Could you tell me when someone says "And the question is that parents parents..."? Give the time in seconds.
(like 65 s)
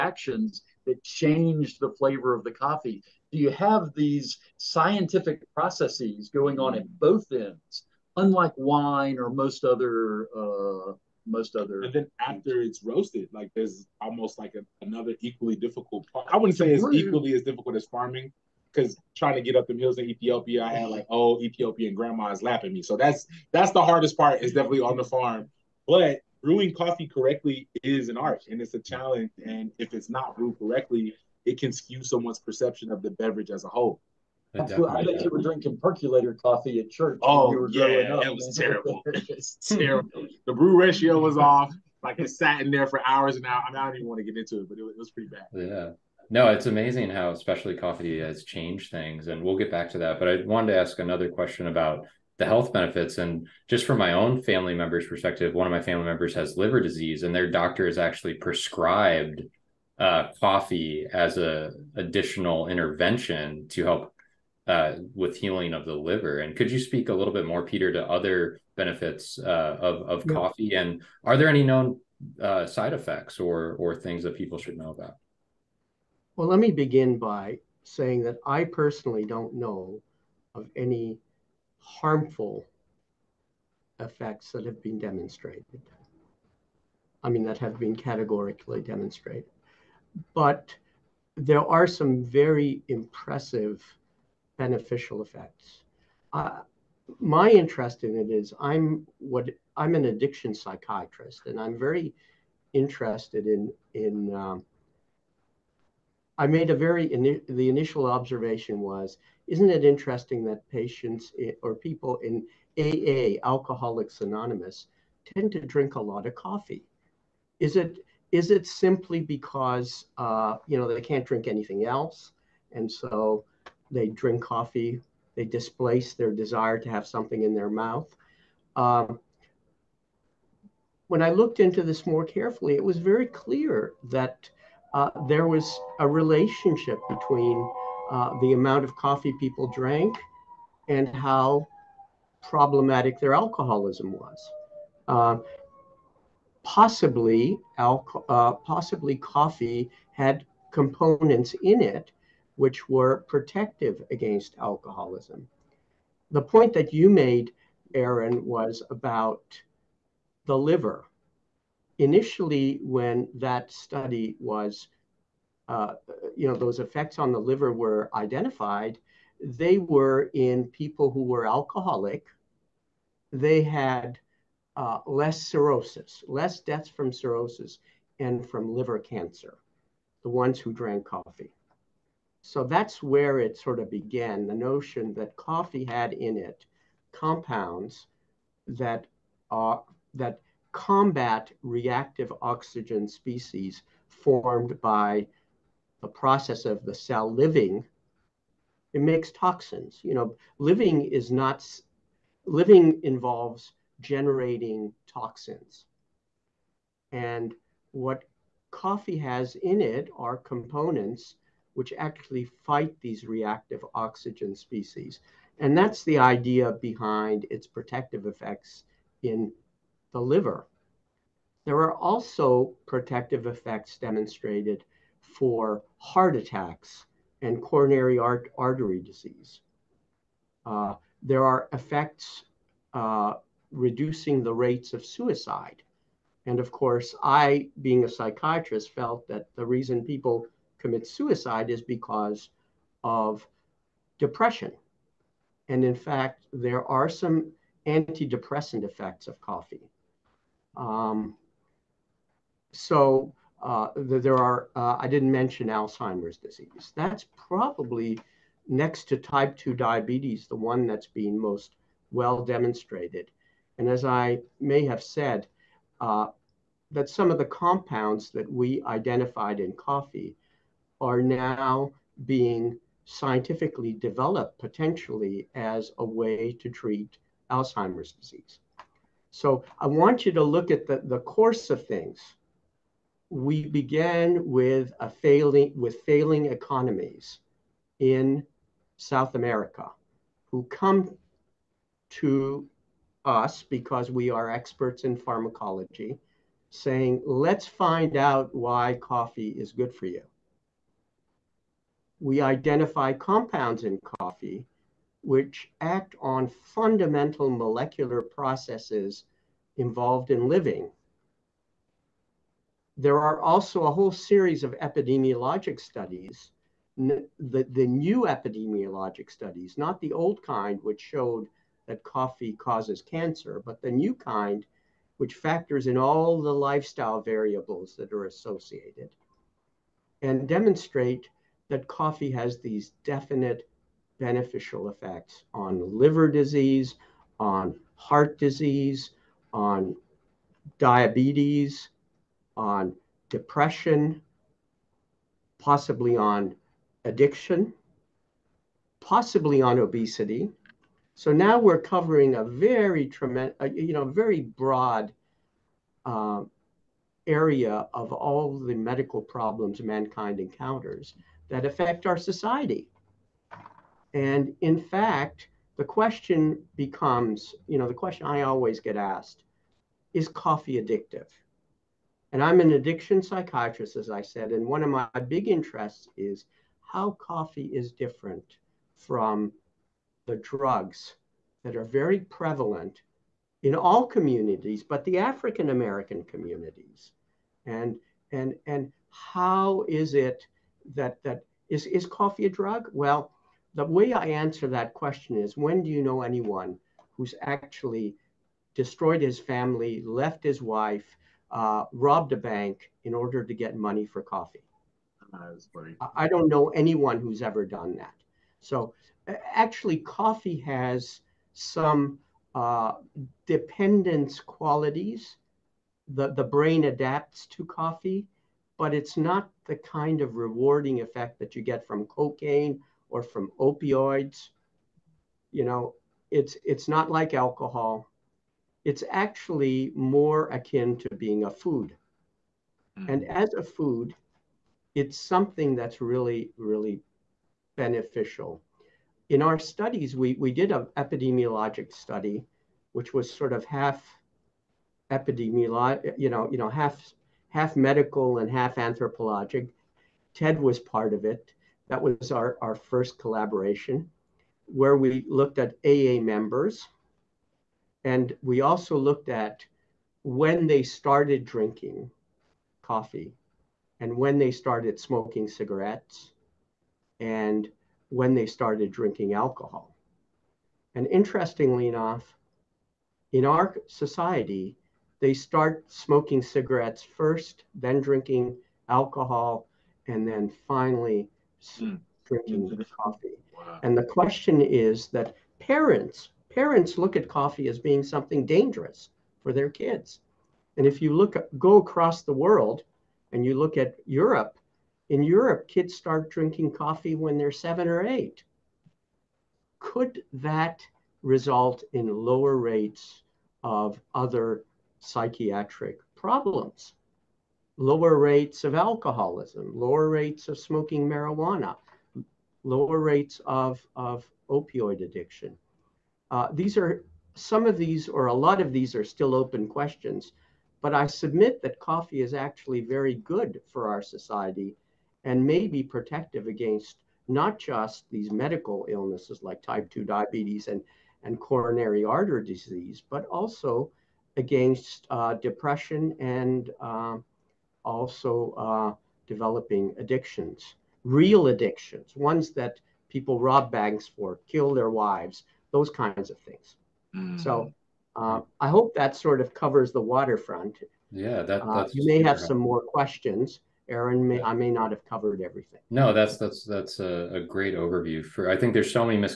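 483 s.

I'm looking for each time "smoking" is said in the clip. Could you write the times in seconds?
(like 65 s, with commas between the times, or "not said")
464 s, 475 s, 510 s.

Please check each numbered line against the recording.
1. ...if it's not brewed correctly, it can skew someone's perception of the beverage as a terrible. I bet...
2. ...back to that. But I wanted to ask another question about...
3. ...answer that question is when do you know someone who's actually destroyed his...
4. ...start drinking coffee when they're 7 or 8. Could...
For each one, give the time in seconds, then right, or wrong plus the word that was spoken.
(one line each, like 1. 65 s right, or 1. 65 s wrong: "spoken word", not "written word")
1. 29 s wrong: "whole", not "terrible"
2. 49 s right
3. 394 s wrong: "anyone", not "someone"
4. 495 s right.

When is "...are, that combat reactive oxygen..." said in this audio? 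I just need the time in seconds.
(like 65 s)
189 s.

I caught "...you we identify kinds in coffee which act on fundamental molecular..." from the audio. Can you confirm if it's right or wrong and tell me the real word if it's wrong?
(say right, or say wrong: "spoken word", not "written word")
wrong: "compounds", not "kinds".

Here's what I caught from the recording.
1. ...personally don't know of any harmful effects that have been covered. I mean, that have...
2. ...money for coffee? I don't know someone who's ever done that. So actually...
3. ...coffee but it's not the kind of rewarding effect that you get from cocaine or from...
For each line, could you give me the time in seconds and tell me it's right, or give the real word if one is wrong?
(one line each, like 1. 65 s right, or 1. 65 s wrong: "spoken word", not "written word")
1. 78 s wrong: "demonstrated", not "covered"
2. 403 s wrong: "anyone", not "someone"
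3. 417 s right.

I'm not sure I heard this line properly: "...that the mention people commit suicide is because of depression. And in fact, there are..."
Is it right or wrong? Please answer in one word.
wrong.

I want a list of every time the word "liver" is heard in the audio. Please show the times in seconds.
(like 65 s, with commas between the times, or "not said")
56 s, 65 s, 160 s, 167 s, 178 s, 220 s, 335 s.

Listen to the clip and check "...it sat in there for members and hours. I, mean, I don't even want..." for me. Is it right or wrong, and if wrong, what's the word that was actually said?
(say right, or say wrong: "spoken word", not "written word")
wrong: "hours", not "members".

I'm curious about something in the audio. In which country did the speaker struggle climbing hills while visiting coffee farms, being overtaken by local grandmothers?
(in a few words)
Ethiopia.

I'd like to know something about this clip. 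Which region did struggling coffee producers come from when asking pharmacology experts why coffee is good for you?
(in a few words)
South America.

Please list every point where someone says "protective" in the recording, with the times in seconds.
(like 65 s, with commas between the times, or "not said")
153 s, 217 s, 222 s, 525 s.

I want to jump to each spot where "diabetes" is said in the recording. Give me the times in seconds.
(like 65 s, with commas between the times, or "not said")
259 s, 340 s, 530 s.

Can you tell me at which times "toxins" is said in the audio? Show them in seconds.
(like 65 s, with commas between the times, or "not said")
199 s, 205 s.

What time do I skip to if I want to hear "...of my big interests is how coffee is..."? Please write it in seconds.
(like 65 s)
374 s.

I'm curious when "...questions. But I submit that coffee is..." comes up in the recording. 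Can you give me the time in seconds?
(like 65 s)
519 s.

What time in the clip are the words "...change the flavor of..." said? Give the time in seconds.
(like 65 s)
1 s.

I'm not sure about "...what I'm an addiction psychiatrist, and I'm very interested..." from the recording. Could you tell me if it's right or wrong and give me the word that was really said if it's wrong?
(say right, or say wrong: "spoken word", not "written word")
right.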